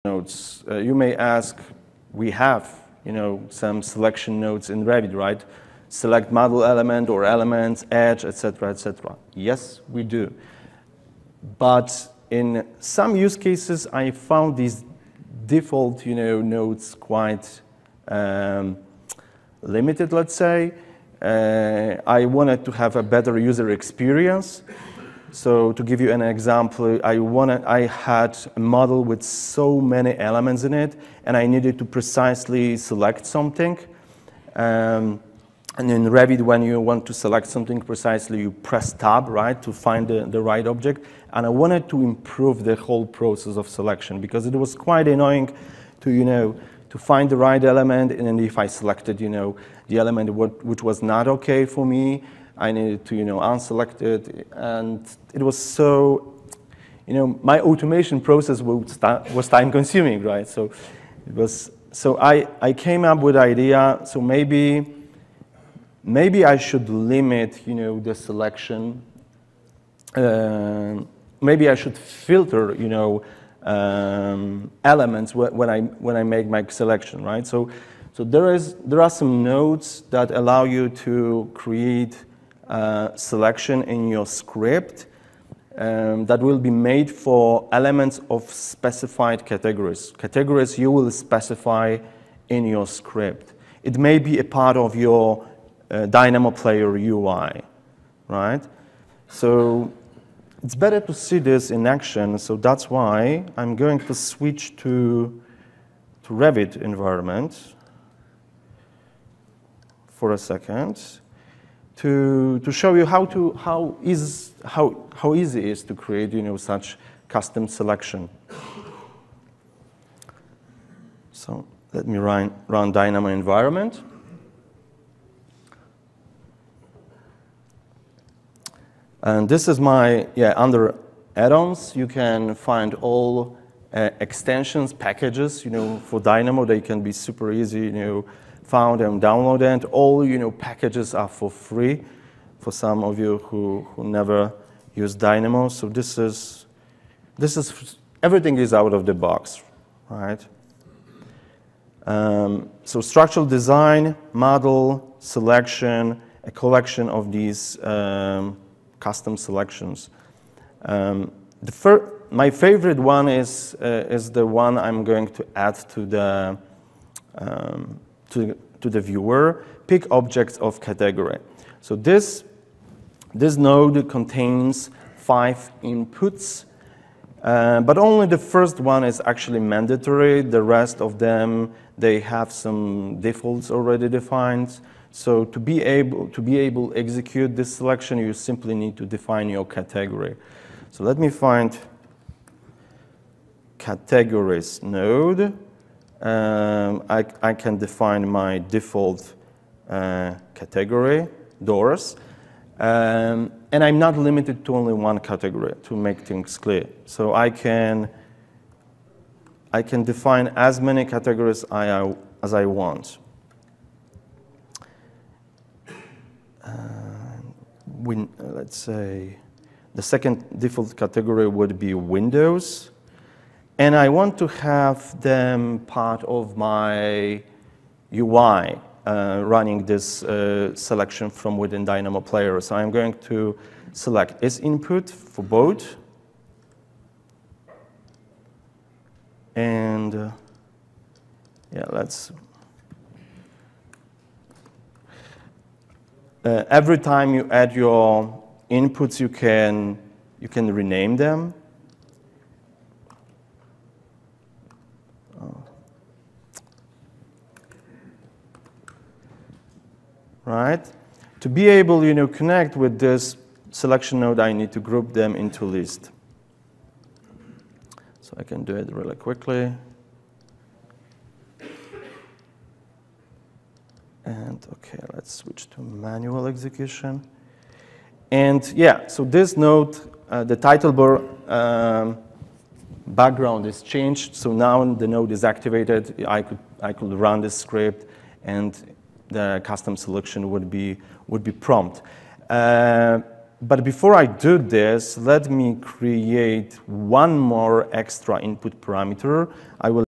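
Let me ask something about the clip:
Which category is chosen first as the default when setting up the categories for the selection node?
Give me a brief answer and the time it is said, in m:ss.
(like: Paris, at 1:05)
Doors, at 3:21.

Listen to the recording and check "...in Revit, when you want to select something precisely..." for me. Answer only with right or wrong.
right.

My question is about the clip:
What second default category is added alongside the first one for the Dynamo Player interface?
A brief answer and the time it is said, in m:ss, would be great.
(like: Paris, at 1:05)
Windows, at 3:41.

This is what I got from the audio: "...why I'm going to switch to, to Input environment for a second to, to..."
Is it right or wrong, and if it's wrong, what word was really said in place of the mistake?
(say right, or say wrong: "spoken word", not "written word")
wrong: "Revit", not "Input".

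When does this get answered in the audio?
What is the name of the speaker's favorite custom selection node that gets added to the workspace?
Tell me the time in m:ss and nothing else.
2:49.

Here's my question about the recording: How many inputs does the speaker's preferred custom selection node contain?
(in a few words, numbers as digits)
5.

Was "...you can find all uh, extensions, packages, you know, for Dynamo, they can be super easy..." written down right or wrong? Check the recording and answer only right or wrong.
right.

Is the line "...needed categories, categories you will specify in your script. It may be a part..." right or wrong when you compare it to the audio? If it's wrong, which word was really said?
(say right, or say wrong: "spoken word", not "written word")
wrong: "specified", not "needed".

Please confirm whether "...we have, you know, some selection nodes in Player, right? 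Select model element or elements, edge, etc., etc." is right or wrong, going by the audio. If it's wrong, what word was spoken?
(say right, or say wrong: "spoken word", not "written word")
wrong: "Revit", not "Player".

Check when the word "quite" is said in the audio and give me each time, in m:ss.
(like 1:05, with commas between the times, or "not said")
0:16, 0:44.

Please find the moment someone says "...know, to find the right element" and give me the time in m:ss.
0:46.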